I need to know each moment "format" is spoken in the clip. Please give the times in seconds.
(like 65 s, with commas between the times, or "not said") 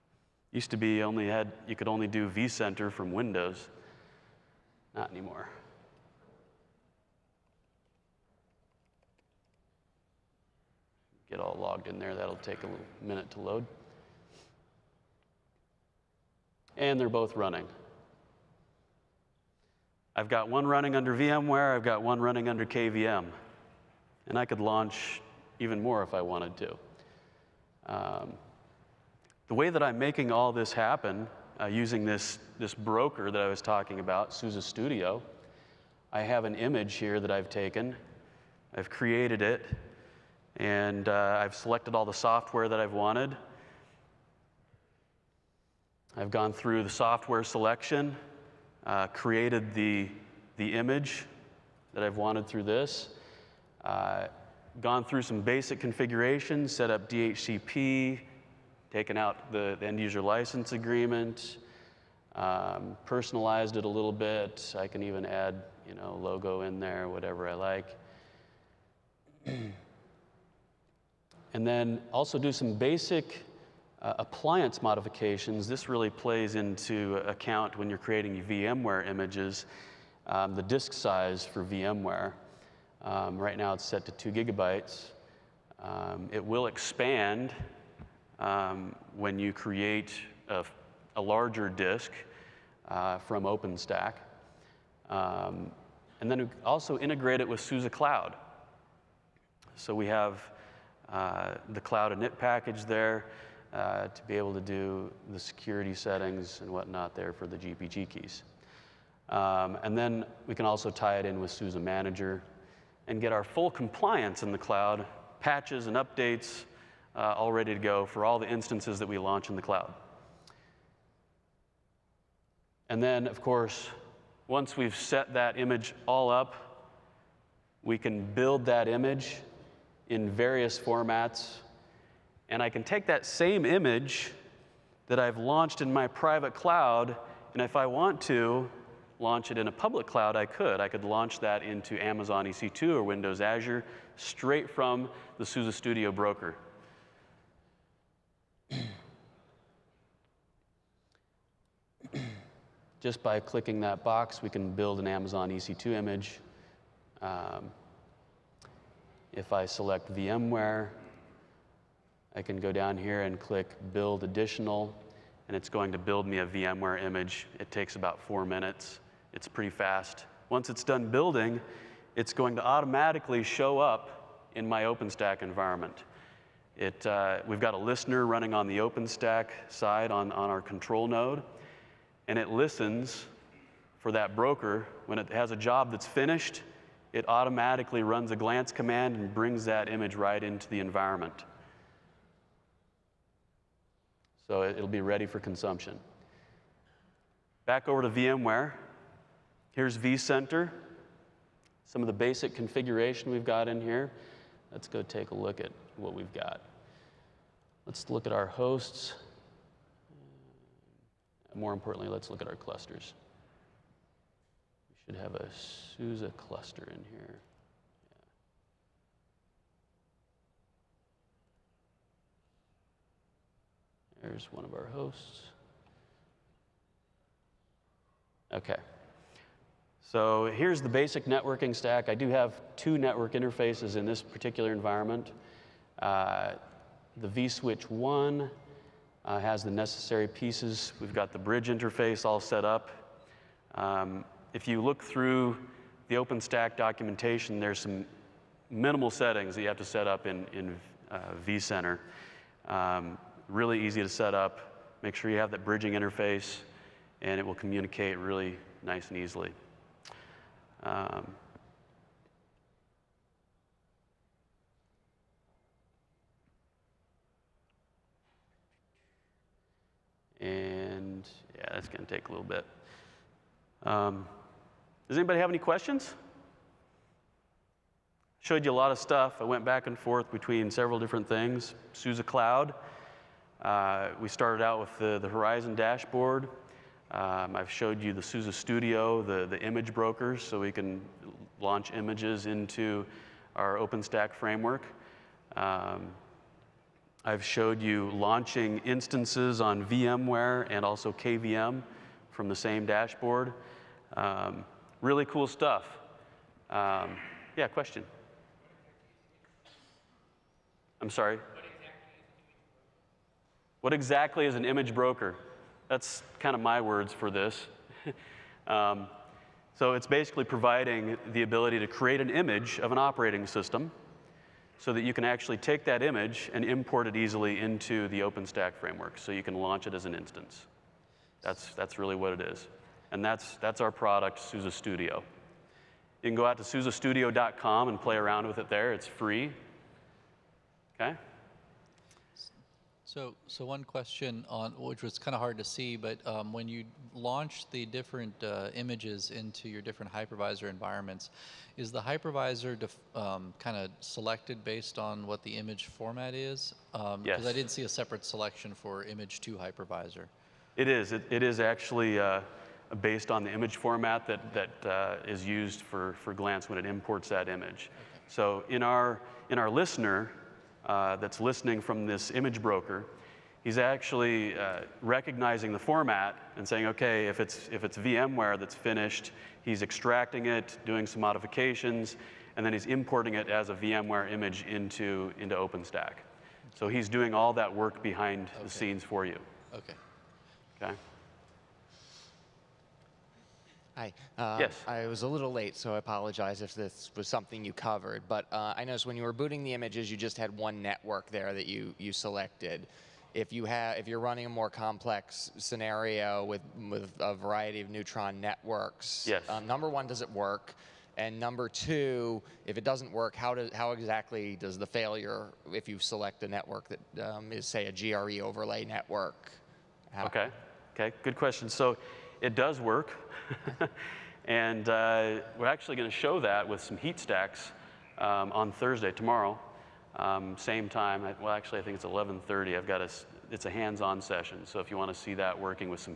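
130 s, 355 s, 363 s, 375 s.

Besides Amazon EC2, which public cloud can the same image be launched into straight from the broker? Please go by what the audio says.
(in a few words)
Windows Azure.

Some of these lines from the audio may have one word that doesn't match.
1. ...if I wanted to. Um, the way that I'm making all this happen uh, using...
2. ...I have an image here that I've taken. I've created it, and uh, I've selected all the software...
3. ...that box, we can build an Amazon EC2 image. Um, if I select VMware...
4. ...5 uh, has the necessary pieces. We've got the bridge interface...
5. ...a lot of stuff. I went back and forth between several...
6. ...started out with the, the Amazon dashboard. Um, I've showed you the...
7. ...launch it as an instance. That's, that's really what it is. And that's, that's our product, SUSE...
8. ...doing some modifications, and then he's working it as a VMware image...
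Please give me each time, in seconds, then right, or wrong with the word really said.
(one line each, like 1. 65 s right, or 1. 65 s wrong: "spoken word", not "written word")
1. 26 s right
2. 36 s right
3. 153 s right
4. 237 s wrong: "1", not "5"
5. 278 s right
6. 284 s wrong: "Horizon", not "Amazon"
7. 329 s right
8. 380 s wrong: "importing", not "working".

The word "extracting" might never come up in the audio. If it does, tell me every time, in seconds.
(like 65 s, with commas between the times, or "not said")
379 s.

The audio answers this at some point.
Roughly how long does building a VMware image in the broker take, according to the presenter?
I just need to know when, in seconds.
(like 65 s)
168 s.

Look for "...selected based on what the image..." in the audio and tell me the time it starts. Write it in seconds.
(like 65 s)
353 s.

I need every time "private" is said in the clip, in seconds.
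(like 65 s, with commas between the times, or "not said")
136 s.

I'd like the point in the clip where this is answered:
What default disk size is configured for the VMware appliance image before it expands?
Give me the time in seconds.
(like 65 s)
84 s.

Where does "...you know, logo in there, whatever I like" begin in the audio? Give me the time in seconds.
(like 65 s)
65 s.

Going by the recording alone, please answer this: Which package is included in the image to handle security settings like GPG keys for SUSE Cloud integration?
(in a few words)
cloud init.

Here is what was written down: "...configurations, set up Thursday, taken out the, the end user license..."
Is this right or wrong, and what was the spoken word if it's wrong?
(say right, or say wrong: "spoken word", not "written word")
wrong: "DHCP", not "Thursday".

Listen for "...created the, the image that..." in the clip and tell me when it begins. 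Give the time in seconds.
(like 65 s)
49 s.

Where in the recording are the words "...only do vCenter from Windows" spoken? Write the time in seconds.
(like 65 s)
1 s.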